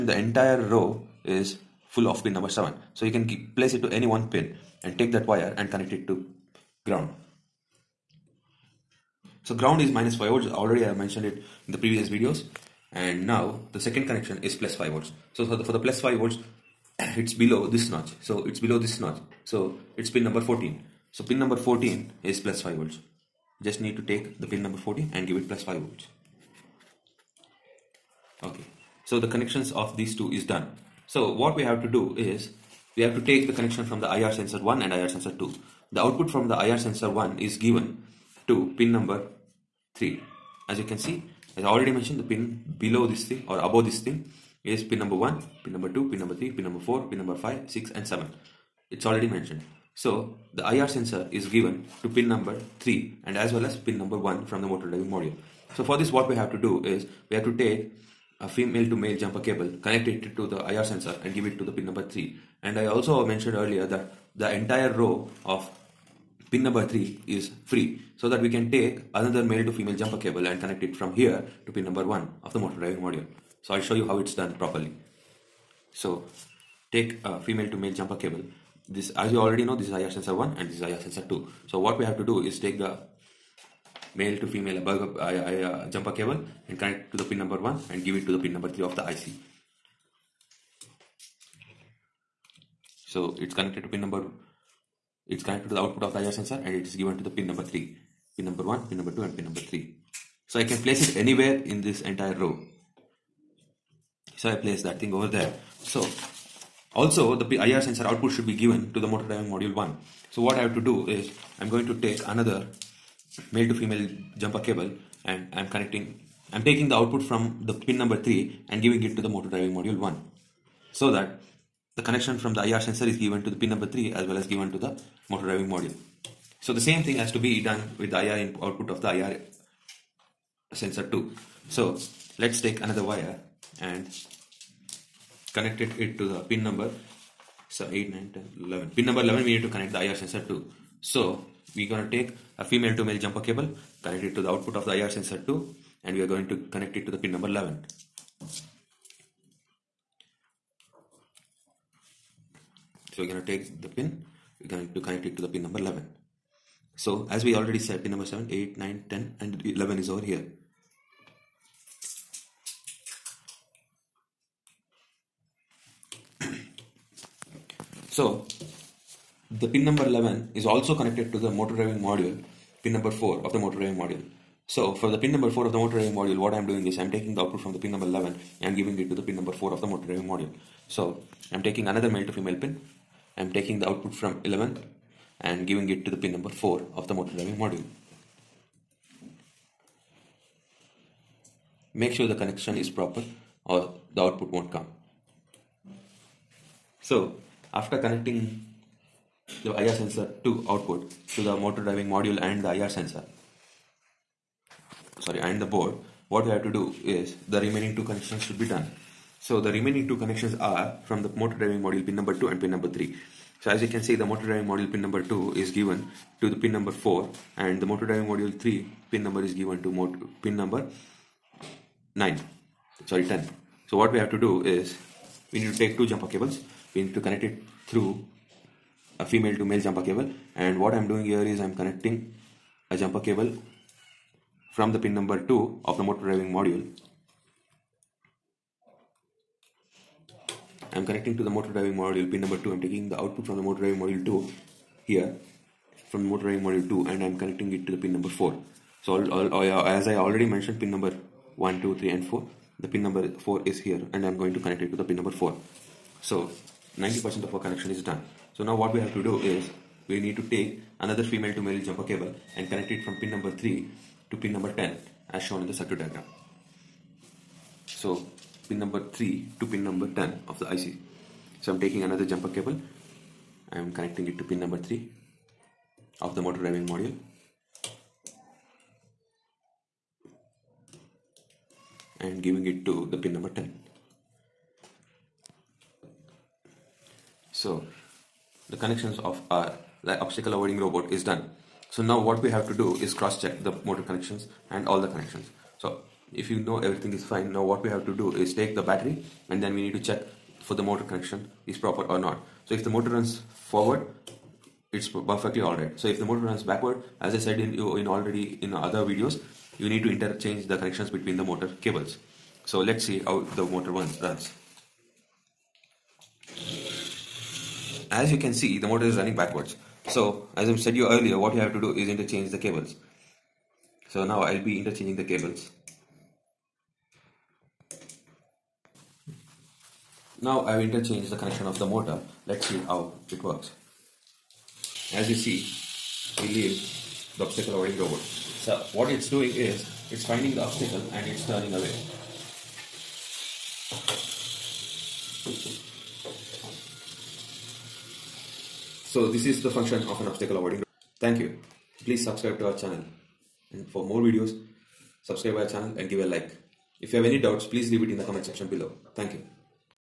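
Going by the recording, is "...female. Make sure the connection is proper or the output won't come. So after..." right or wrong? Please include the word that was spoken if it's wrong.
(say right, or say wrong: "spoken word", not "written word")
wrong: "module", not "female".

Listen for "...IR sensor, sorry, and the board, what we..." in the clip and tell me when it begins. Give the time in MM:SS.
03:22.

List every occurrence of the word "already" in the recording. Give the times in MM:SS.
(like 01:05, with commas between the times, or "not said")
00:10, 00:41, 00:49, 01:19, 02:37, 04:10, 05:08.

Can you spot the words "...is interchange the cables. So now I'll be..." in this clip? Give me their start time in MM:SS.
05:21.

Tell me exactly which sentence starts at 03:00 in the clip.
So I am taking another male to female pin.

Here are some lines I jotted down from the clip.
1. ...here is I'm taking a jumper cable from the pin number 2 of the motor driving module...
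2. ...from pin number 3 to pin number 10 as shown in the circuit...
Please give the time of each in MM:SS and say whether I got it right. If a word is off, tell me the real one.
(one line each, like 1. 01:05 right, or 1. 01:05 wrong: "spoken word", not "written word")
1. 03:51 wrong: "connecting", not "taking"
2. 04:23 right.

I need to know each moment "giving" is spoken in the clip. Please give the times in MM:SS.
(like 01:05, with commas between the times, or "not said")
01:58, 02:58, 03:05, 04:42.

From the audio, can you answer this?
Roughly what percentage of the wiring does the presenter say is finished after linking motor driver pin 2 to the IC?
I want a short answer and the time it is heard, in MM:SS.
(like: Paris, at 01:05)
90%, at 04:16.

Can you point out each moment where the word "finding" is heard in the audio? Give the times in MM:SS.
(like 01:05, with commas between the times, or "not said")
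05:40.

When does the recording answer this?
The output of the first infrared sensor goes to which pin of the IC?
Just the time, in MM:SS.
00:50.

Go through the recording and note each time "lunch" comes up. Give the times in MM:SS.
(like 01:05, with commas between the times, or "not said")
not said.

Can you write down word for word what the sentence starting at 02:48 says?
so the pin number 11 is also connected to the motor driving module, pin number 4 of the motor driving module.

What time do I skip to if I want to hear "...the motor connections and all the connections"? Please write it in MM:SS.
04:53.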